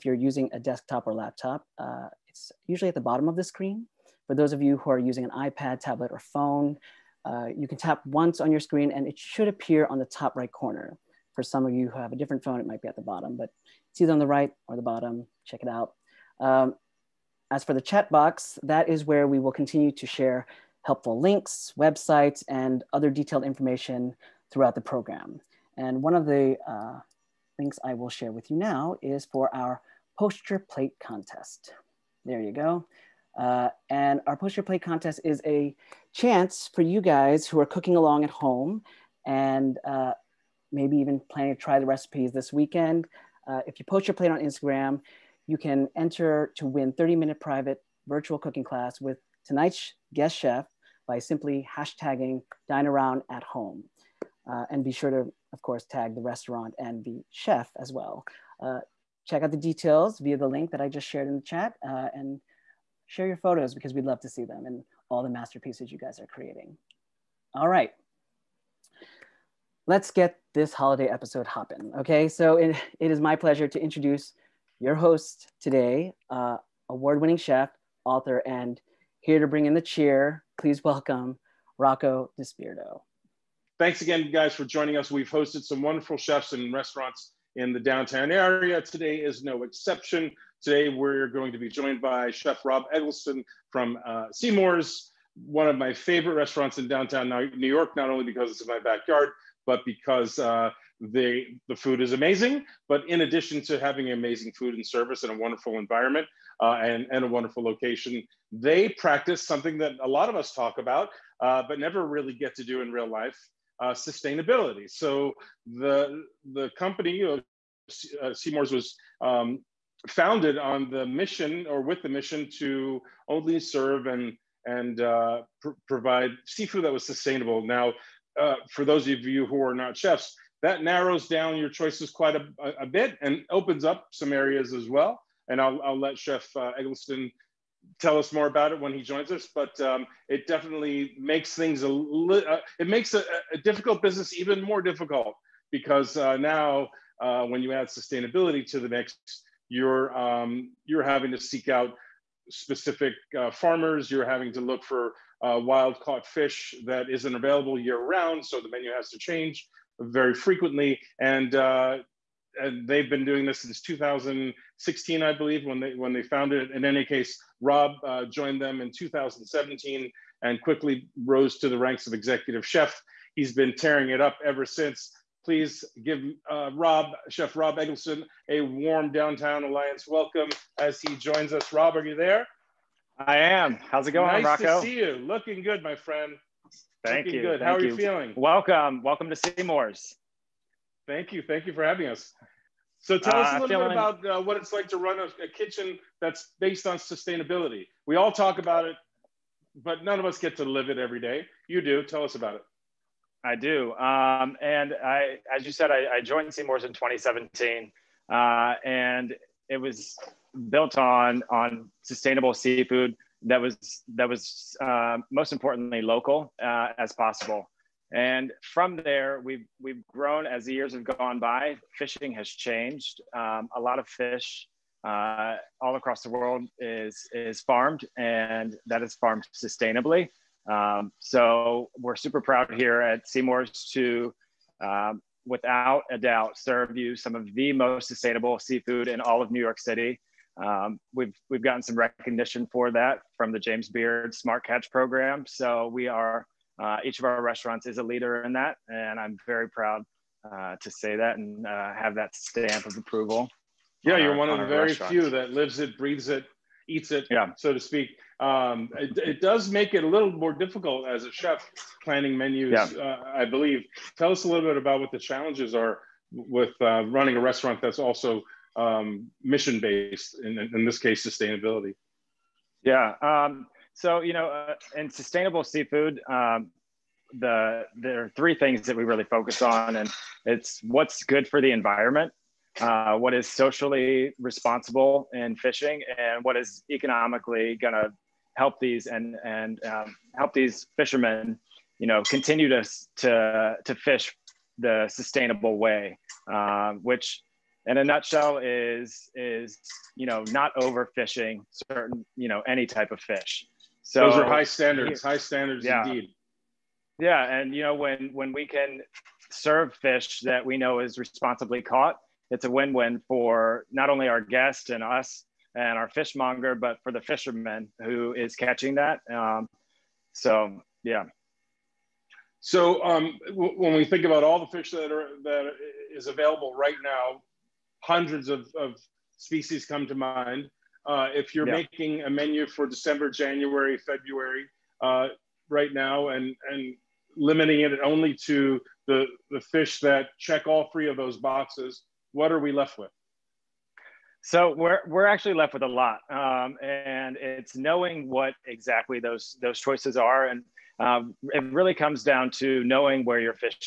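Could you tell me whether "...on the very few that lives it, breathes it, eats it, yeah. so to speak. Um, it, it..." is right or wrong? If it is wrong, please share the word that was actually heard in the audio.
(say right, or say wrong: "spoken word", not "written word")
right.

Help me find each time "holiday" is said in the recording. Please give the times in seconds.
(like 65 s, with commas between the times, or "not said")
70 s.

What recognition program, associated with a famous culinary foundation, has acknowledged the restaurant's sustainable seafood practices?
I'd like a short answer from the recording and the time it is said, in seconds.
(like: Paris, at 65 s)
James Beard Smart Catch, at 243 s.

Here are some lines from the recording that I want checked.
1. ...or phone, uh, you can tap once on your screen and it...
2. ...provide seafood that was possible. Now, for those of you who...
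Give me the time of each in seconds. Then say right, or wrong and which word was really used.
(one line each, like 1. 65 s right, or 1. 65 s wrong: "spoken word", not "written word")
1. 6 s right
2. 125 s wrong: "sustainable", not "possible".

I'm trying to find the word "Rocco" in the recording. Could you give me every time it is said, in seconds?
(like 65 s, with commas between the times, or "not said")
81 s, 184 s.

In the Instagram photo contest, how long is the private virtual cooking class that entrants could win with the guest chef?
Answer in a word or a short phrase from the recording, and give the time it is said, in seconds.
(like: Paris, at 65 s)
30 minute, at 46 s.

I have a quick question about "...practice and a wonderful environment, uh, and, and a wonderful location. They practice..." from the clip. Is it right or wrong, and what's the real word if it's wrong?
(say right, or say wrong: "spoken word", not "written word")
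wrong: "service", not "practice".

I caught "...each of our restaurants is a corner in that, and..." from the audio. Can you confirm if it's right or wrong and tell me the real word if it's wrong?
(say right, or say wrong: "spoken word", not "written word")
wrong: "leader", not "corner".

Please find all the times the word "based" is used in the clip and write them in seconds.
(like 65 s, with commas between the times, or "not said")
196 s, 269 s.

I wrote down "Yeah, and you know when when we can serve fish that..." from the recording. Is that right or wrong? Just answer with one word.
right.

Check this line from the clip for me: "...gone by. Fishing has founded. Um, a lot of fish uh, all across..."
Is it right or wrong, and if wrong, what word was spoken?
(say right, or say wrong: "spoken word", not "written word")
wrong: "changed", not "founded".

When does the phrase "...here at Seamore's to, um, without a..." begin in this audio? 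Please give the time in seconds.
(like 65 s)
232 s.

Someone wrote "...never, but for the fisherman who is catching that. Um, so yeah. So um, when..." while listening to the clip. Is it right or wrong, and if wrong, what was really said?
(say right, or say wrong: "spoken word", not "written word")
wrong: "fishmonger", not "never".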